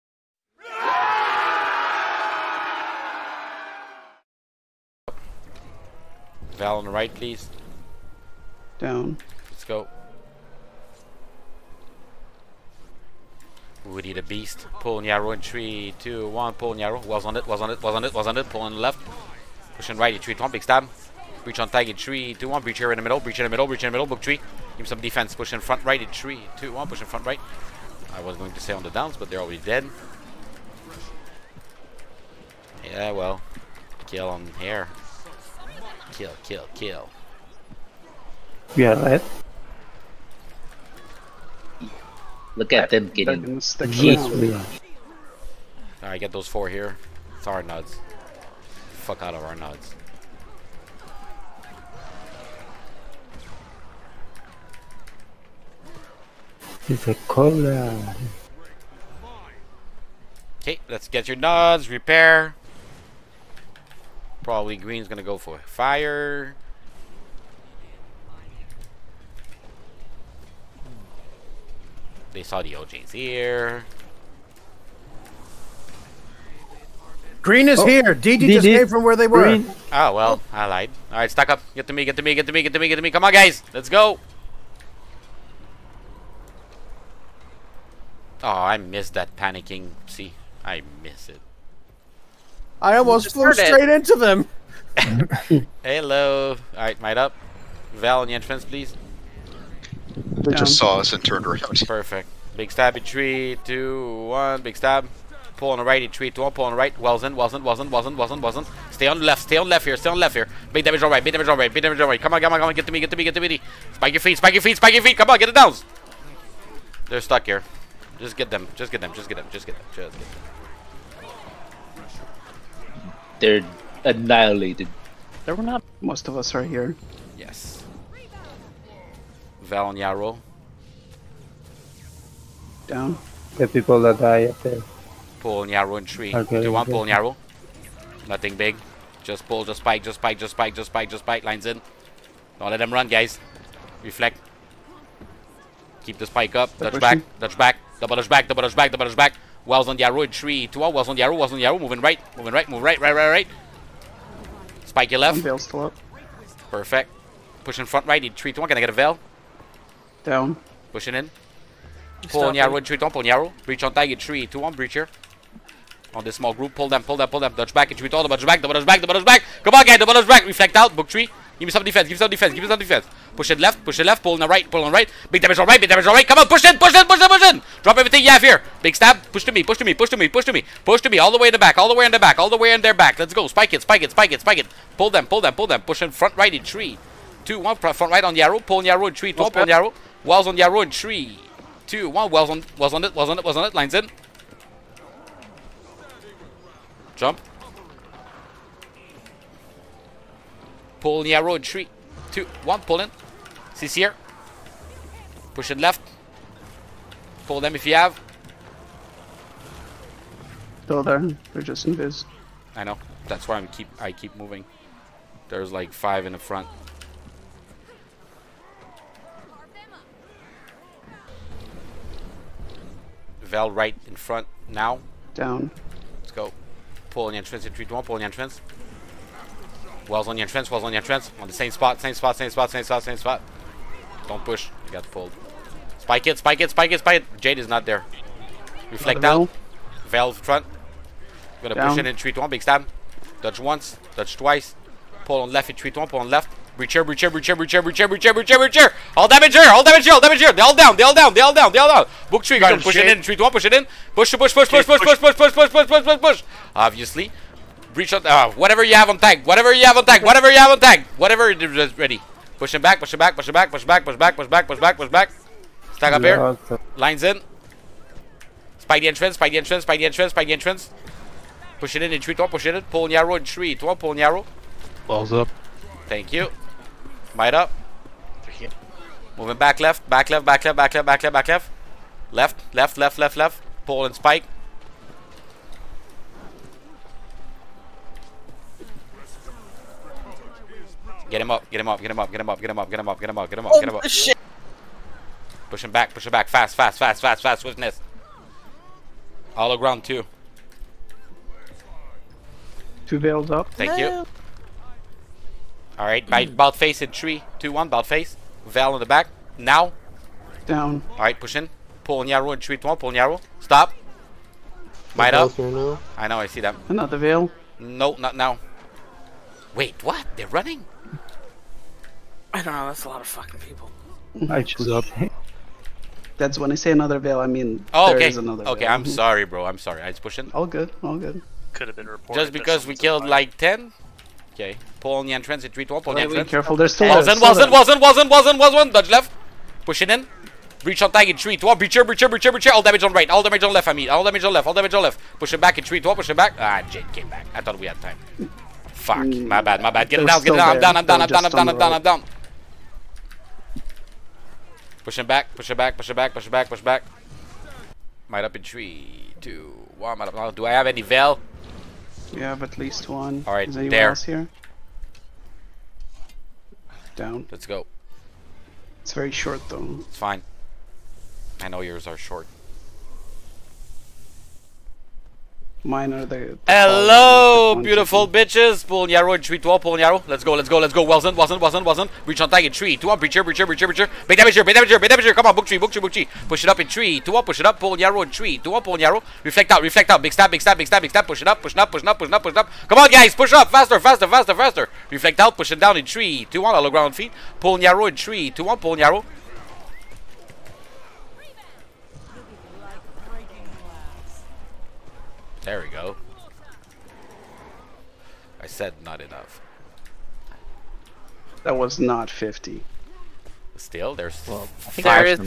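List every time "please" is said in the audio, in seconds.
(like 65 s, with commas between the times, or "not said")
7 s, 98 s.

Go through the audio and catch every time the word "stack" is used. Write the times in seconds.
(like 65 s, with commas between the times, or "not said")
81 s, 265 s.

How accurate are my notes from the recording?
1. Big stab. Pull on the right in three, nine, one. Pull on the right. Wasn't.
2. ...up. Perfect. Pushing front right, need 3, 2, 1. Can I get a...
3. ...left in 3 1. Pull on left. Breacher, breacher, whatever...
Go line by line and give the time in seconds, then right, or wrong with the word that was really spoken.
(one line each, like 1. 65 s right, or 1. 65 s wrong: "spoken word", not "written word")
1. 104 s wrong: "two", not "nine"
2. 155 s right
3. 245 s wrong: "breacher", not "whatever".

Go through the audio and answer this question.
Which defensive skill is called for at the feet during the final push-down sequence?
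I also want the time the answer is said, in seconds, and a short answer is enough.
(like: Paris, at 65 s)
hallowed ground, at 396 s.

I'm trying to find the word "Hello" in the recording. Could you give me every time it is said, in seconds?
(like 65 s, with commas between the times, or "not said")
95 s, 376 s.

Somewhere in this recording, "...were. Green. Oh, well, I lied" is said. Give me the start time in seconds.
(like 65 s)
79 s.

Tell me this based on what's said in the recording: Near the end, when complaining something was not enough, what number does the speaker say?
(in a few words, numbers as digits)
50.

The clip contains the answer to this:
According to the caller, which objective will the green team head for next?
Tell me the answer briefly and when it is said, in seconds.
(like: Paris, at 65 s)
fire, at 65 s.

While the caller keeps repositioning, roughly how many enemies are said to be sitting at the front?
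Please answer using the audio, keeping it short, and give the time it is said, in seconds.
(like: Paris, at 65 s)
5, at 215 s.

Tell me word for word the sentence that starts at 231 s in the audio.
On the same spot, same spot, same spot, same spot, same spot.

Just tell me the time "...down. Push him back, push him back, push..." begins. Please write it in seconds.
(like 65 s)
352 s.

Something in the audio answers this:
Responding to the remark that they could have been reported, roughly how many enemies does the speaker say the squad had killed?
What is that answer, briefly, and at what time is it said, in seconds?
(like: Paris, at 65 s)
10, at 333 s.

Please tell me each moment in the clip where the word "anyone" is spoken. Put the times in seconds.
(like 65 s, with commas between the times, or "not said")
363 s.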